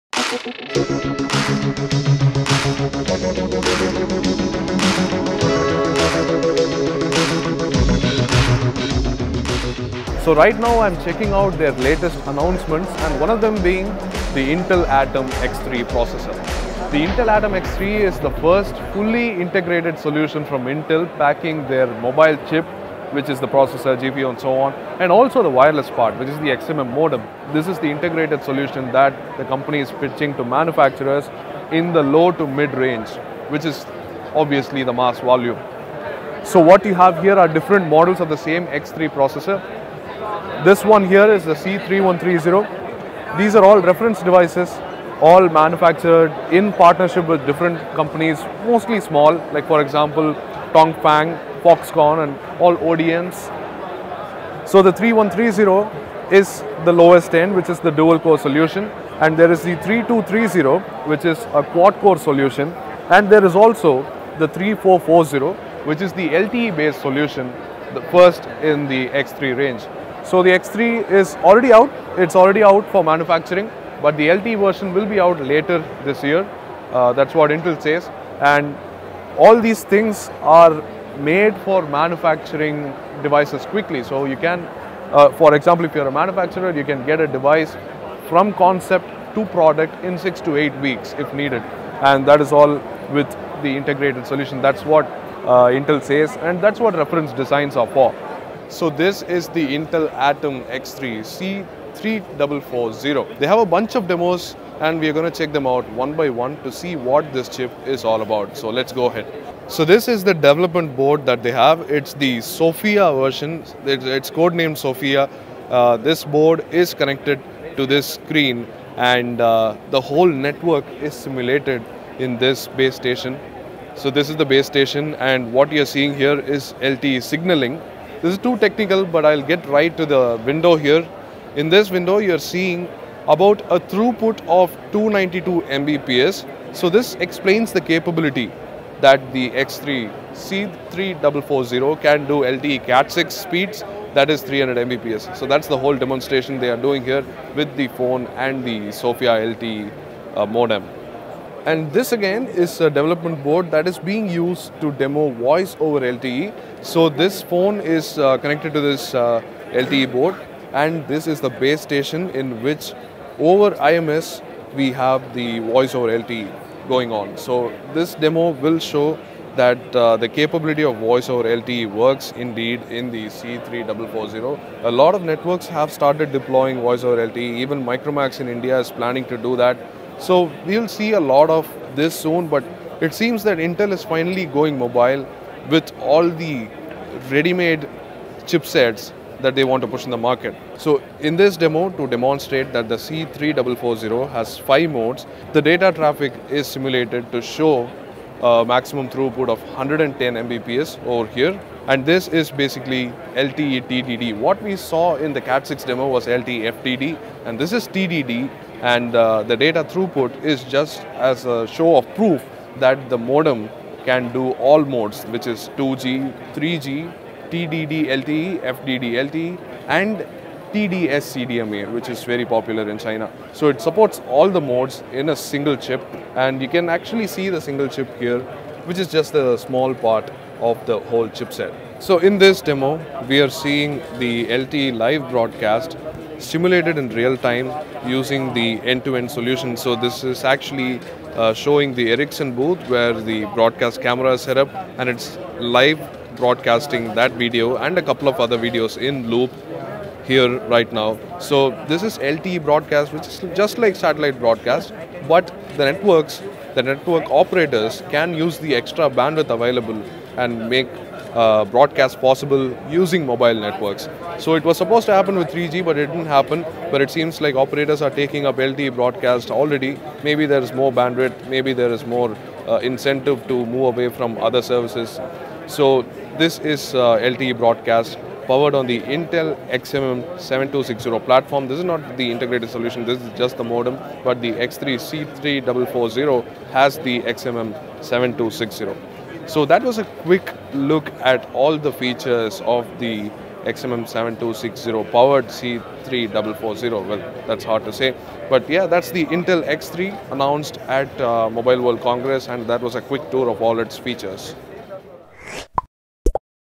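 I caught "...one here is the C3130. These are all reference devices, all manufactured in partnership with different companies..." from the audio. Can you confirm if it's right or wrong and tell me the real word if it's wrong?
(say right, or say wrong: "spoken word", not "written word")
right.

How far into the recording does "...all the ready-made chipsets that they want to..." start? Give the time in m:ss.
3:05.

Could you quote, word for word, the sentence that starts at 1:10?
So the X3 is already out, it's already out for manufacturing, but the LTE version will be out later this year.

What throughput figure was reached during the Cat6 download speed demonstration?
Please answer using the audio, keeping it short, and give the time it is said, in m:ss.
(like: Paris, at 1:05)
292 Mbps, at 2:14.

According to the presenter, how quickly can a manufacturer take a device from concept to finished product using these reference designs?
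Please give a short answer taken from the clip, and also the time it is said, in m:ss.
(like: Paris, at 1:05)
6 to 8 weeks, at 1:30.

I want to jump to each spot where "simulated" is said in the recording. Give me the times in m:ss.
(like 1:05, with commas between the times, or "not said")
2:01, 3:16, 3:56.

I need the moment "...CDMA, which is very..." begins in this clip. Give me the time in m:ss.
3:41.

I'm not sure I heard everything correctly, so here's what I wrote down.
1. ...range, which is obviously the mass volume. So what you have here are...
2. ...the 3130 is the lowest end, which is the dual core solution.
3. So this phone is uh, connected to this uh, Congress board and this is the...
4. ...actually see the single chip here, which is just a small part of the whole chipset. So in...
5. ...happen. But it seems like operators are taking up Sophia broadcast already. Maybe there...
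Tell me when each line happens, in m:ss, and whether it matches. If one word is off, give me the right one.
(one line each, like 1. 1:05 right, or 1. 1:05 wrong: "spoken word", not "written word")
1. 0:32 right
2. 0:54 right
3. 2:36 wrong: "LTE", not "Congress"
4. 3:46 right
5. 4:26 wrong: "LTE", not "Sophia".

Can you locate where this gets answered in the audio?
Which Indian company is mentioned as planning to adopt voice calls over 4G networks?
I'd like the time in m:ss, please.
2:57.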